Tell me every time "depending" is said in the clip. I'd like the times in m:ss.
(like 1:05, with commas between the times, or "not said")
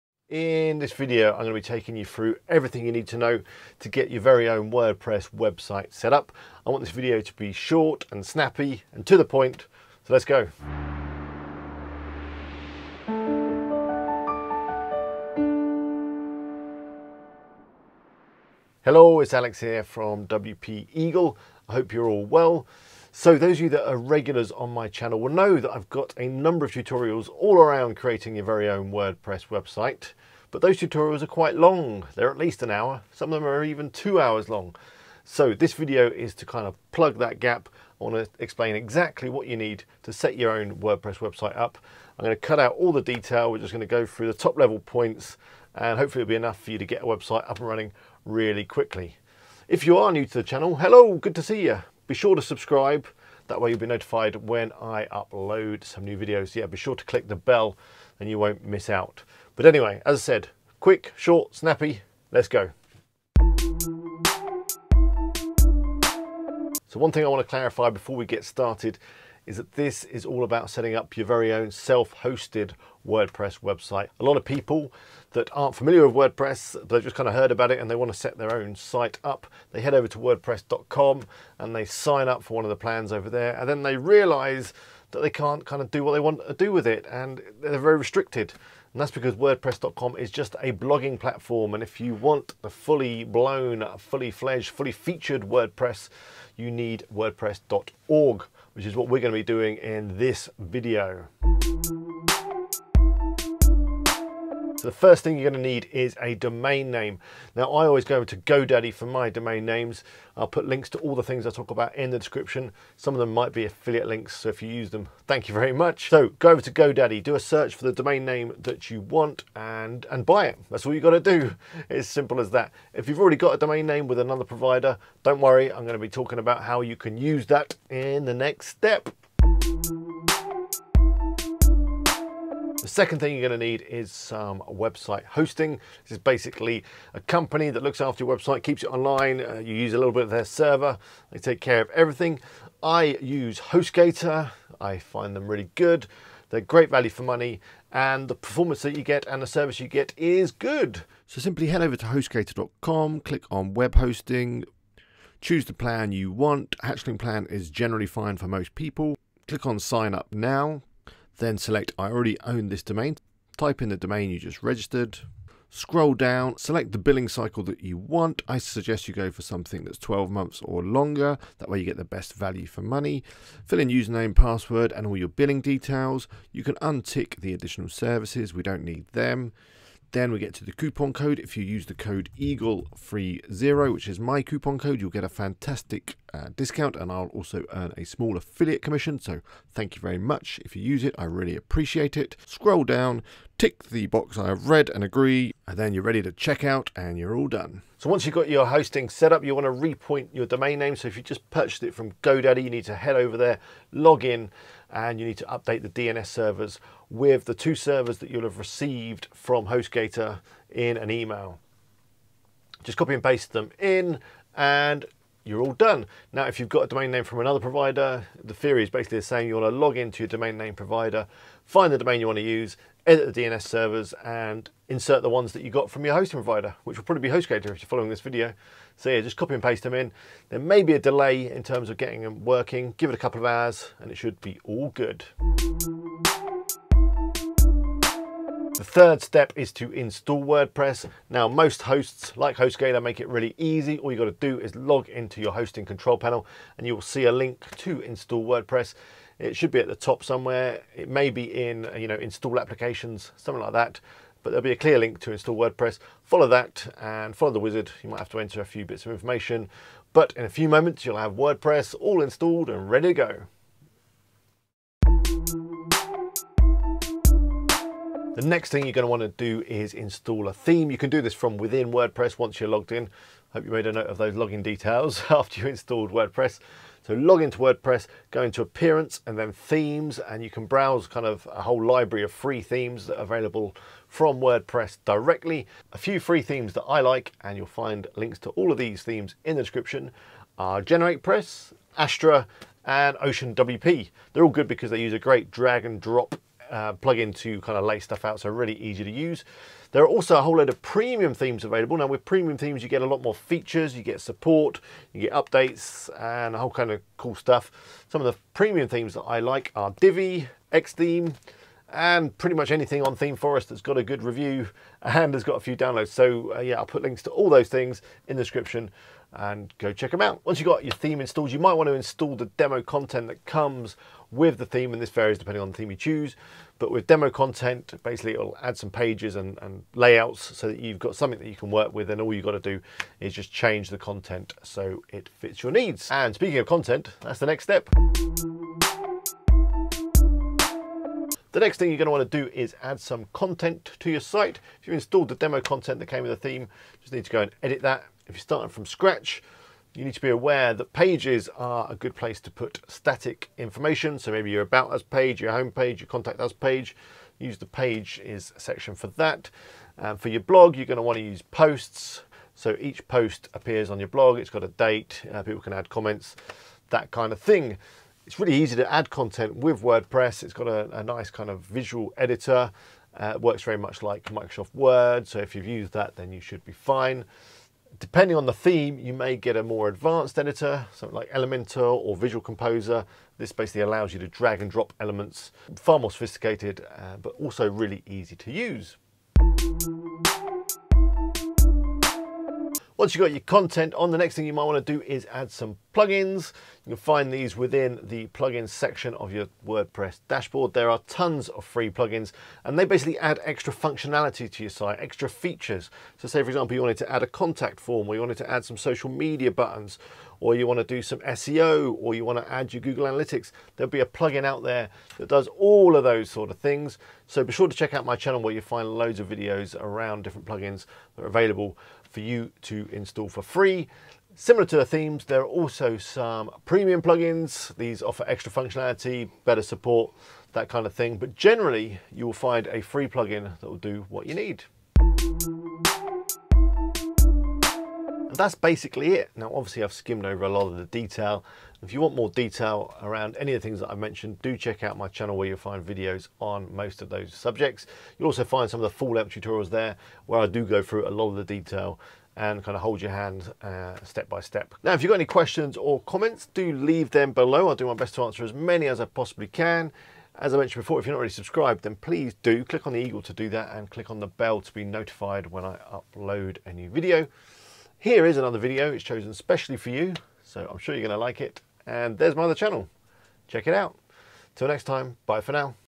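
5:25, 6:17.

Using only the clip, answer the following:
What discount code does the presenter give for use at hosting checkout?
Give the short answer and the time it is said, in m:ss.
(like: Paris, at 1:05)
EAGLE30, at 3:02.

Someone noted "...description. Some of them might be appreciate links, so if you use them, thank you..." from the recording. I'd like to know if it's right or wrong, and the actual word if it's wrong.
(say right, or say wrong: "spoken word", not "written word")
wrong: "affiliate", not "appreciate".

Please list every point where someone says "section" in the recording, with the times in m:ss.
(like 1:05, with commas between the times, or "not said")
5:58, 6:38.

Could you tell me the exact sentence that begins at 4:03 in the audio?
All you gotta do is log into your hosting control panel and you will see a link to install WordPress.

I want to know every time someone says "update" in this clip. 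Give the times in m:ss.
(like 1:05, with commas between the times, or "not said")
3:25, 5:05.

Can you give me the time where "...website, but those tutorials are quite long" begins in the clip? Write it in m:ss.
0:29.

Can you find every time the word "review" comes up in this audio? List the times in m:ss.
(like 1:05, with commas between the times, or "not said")
5:14.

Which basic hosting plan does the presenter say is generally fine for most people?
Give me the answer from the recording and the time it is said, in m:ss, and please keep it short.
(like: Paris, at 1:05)
Hatchling, at 2:36.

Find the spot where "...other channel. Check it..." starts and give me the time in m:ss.
7:52.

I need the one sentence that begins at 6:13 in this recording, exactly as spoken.
Uh, works very much like Microsoft Word.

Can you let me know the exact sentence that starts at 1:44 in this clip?
So the first thing you're going to need is a domain name.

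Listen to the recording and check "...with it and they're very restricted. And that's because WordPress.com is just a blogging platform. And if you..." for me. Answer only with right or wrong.
right.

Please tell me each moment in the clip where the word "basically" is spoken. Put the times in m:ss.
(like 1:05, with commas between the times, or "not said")
2:16, 3:38, 5:28, 6:23, 6:42, 7:18.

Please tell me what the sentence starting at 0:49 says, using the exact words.
If you are new to the channel, hello, good to see you.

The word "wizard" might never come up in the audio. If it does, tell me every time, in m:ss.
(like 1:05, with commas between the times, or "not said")
4:17.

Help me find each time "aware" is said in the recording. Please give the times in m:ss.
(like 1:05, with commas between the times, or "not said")
5:50.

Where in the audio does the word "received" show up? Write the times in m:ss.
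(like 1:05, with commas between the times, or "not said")
3:28.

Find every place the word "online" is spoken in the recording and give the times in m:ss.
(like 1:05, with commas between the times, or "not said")
2:18.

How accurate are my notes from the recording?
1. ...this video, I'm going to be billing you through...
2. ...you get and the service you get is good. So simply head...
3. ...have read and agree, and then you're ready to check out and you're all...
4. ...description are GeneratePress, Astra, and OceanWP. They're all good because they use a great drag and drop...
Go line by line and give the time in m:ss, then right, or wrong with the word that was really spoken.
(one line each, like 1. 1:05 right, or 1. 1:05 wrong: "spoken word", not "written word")
1. 0:00 wrong: "taking", not "billing"
2. 2:28 right
3. 3:14 right
4. 4:49 right.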